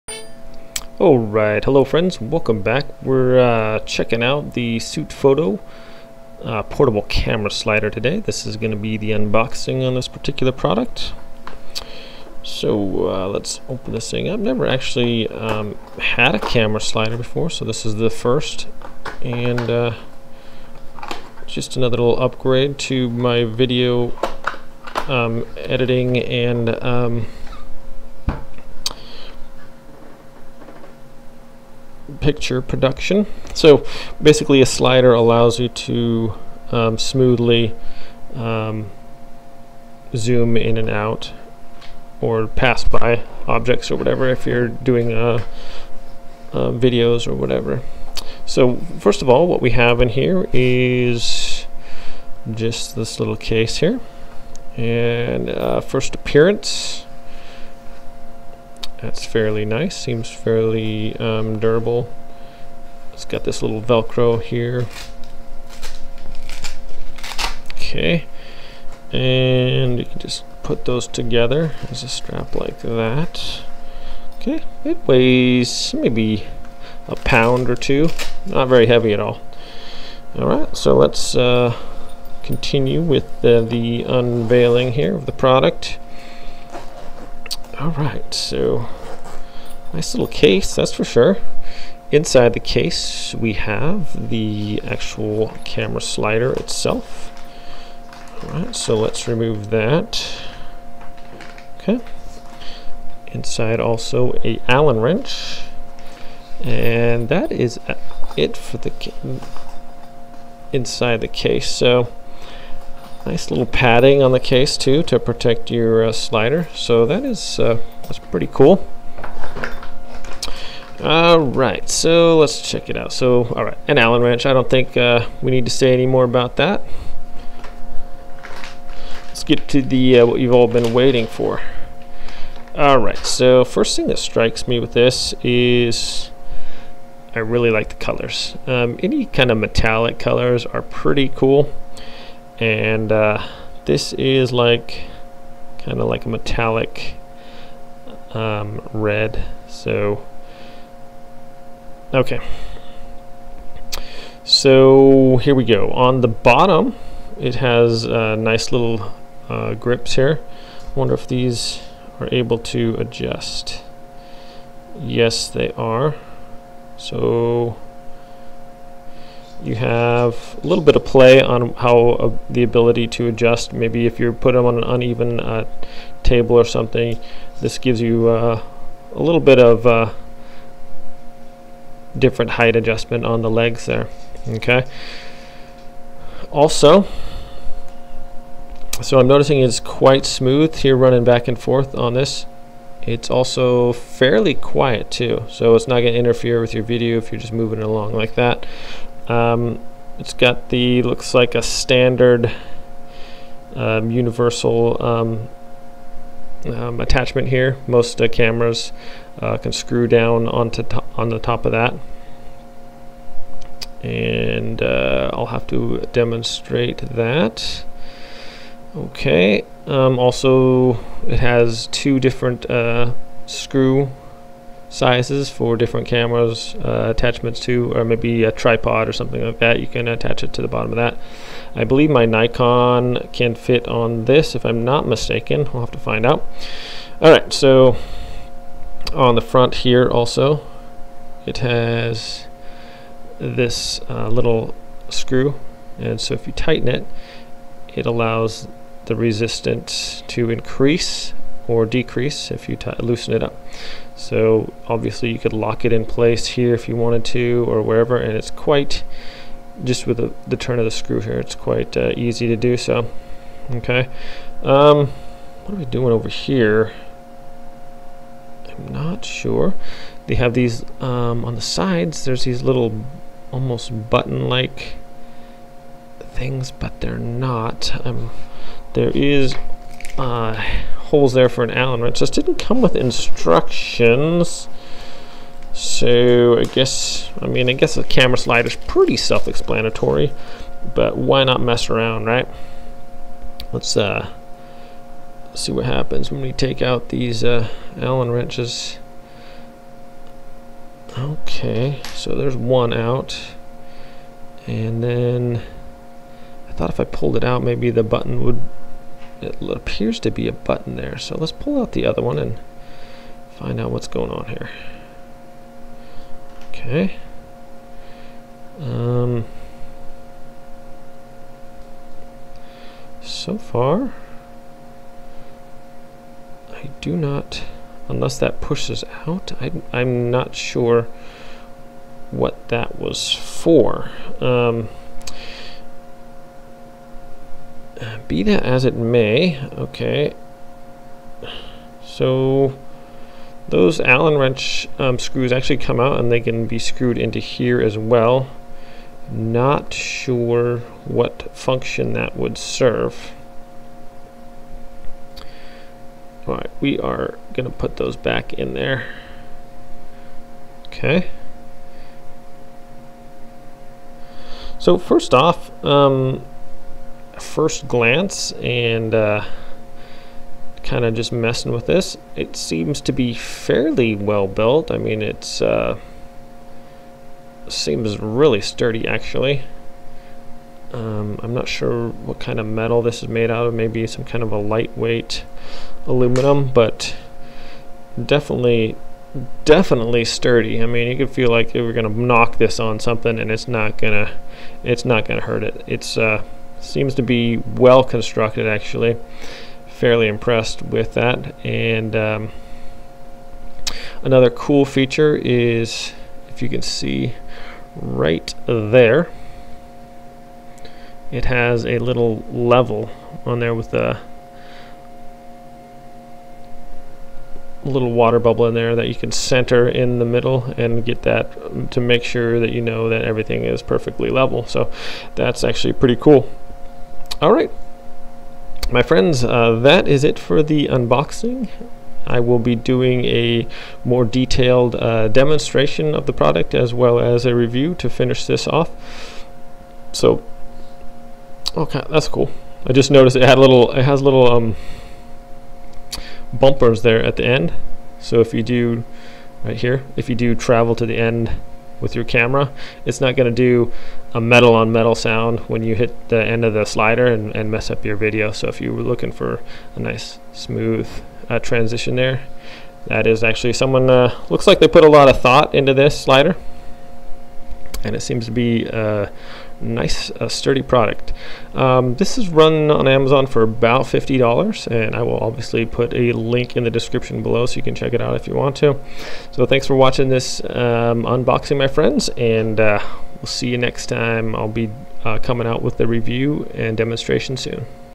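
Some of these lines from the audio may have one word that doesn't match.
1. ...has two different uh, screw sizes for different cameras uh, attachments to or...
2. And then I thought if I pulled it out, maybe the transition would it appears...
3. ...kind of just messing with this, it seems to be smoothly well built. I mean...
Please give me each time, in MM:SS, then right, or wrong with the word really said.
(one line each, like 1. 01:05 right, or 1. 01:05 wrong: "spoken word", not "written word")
1. 03:41 right
2. 05:04 wrong: "button", not "transition"
3. 06:10 wrong: "fairly", not "smoothly".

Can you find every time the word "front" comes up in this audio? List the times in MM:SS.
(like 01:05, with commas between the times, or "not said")
03:59.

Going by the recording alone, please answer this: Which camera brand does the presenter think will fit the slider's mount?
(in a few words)
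Nikon.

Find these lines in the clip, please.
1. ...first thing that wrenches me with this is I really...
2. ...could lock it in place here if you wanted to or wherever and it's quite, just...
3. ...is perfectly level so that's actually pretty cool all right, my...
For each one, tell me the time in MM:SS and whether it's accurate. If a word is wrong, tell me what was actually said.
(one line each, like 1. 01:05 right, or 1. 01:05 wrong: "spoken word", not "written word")
1. 02:13 wrong: "strikes", not "wrenches"
2. 04:15 right
3. 07:03 right.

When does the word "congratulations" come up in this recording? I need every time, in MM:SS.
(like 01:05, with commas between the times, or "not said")
not said.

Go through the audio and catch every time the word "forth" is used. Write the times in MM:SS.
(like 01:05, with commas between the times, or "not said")
03:11.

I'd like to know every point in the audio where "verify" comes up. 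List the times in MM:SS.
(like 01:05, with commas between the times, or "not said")
not said.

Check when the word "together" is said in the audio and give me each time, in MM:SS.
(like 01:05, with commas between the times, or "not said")
01:11.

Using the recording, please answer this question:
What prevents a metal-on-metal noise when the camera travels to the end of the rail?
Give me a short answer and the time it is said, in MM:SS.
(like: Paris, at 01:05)
bumpers, at 07:26.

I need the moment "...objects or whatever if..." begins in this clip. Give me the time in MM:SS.
00:43.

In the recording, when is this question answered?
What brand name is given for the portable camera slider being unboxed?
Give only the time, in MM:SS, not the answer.
00:04.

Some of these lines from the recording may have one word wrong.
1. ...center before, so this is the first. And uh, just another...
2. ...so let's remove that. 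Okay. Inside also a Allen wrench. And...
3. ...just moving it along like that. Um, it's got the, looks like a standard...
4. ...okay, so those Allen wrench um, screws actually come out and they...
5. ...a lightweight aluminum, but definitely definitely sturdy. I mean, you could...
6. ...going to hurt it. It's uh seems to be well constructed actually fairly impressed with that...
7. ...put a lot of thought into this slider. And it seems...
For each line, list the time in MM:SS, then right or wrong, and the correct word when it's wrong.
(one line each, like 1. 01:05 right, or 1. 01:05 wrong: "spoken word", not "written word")
1. 00:16 wrong: "slider", not "center"
2. 01:38 right
3. 03:17 right
4. 05:39 right
5. 06:24 right
6. 06:35 right
7. 07:44 right.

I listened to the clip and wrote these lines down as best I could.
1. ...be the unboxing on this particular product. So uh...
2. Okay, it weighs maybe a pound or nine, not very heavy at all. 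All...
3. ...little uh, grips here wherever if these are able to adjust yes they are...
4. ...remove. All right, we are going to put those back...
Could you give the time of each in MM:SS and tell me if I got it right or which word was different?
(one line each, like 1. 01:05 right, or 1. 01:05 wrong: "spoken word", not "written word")
1. 00:08 right
2. 01:14 wrong: "two", not "nine"
3. 02:38 wrong: "wonder", not "wherever"
4. 05:52 wrong: "serve", not "remove".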